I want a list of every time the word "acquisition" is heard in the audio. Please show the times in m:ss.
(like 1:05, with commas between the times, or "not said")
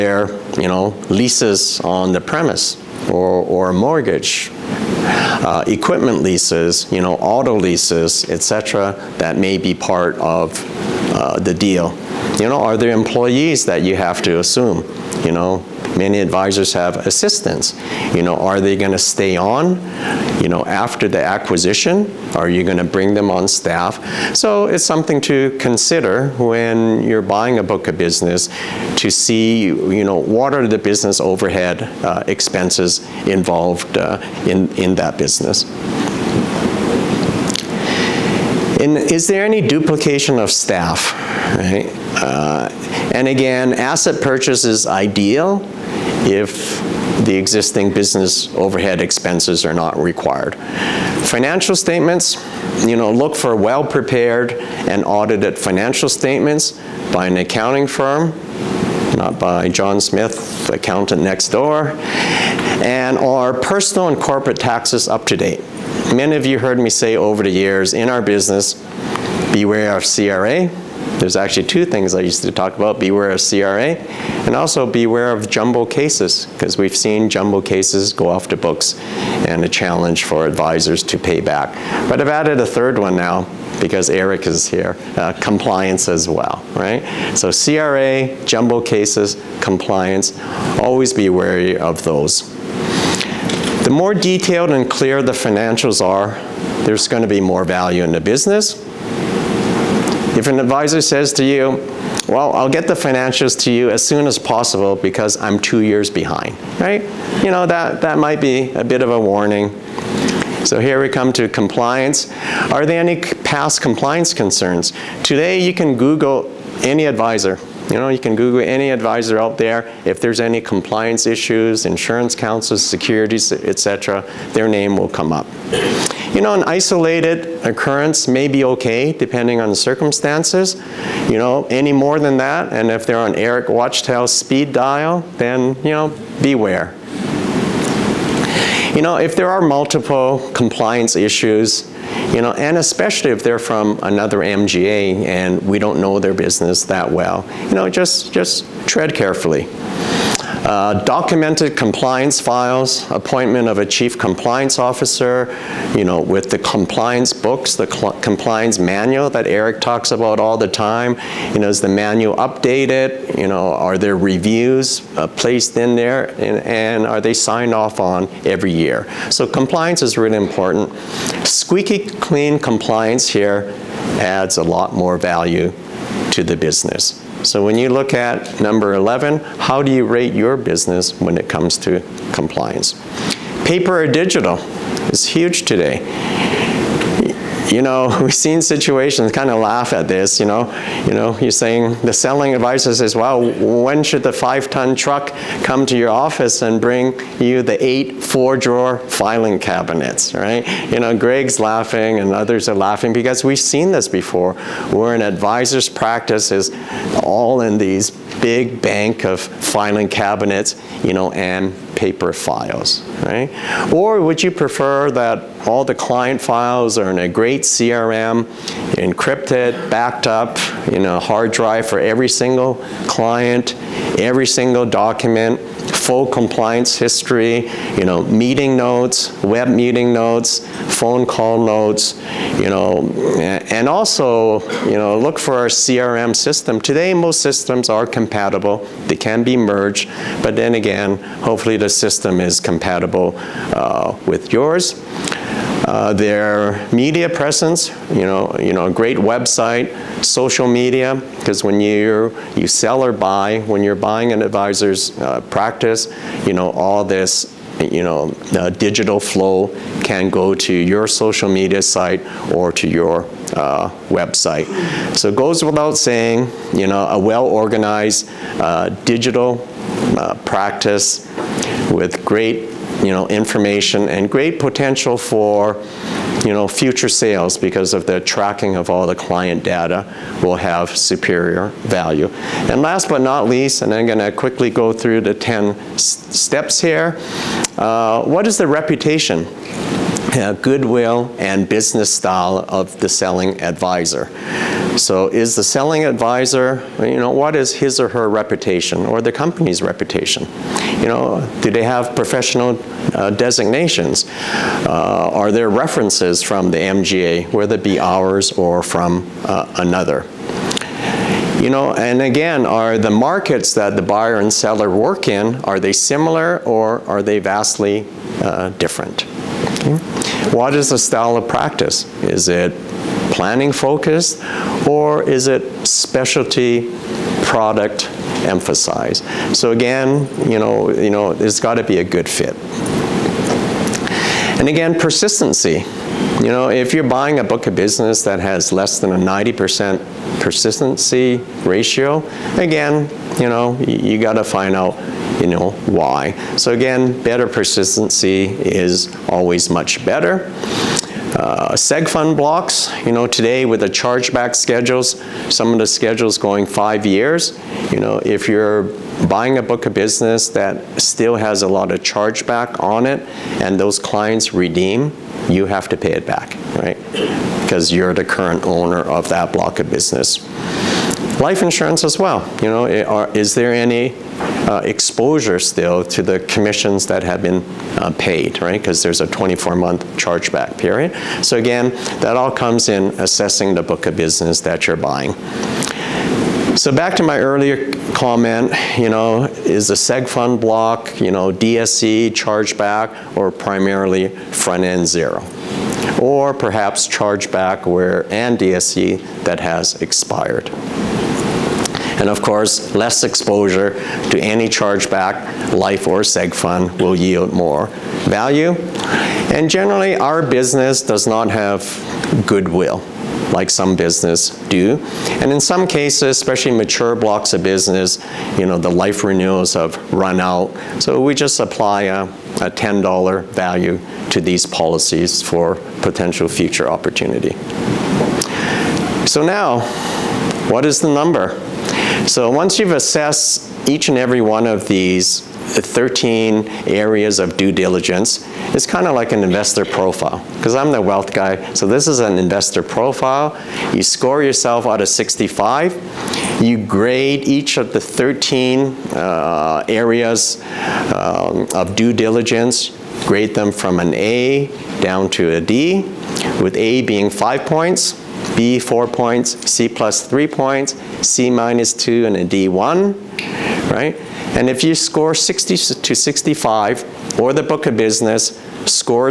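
0:21.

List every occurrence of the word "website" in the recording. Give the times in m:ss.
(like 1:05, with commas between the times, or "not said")
4:09, 4:24.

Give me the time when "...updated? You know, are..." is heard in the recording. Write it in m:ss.
2:42.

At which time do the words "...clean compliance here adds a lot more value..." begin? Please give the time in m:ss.
2:52.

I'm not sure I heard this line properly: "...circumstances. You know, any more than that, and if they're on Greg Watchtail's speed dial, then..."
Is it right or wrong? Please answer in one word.
wrong.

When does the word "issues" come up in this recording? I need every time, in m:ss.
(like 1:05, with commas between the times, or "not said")
2:01, 2:21.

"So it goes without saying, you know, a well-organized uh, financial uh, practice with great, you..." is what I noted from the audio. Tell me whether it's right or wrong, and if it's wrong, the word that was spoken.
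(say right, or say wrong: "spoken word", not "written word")
wrong: "digital", not "financial".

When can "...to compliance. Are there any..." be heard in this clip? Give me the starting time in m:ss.
1:51.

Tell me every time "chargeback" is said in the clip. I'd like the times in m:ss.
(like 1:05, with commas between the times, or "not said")
5:53, 6:02, 6:20, 6:32, 6:37, 6:44.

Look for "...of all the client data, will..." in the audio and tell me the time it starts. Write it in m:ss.
4:38.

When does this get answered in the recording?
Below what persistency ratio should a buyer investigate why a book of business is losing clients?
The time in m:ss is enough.
5:39.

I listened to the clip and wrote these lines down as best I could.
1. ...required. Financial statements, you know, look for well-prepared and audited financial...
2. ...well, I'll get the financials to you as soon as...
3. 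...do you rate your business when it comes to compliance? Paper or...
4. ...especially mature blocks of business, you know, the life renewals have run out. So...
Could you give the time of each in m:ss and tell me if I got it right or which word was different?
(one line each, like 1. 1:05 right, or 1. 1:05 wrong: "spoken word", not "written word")
1. 0:49 right
2. 1:42 right
3. 2:59 right
4. 6:56 right.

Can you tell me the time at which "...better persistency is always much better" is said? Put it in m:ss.
5:47.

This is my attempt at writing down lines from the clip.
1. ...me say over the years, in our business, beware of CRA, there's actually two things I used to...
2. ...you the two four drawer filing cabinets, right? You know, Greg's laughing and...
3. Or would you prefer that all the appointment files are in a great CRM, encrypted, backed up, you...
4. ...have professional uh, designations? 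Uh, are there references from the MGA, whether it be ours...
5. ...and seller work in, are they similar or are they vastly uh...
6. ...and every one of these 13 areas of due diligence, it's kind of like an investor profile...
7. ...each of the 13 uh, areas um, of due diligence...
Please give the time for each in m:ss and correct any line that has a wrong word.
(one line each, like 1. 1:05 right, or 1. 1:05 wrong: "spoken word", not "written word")
1. 1:06 right
2. 3:17 wrong: "eight", not "two"
3. 3:33 wrong: "client", not "appointment"
4. 5:01 right
5. 5:14 right
6. 7:14 right
7. 7:27 right.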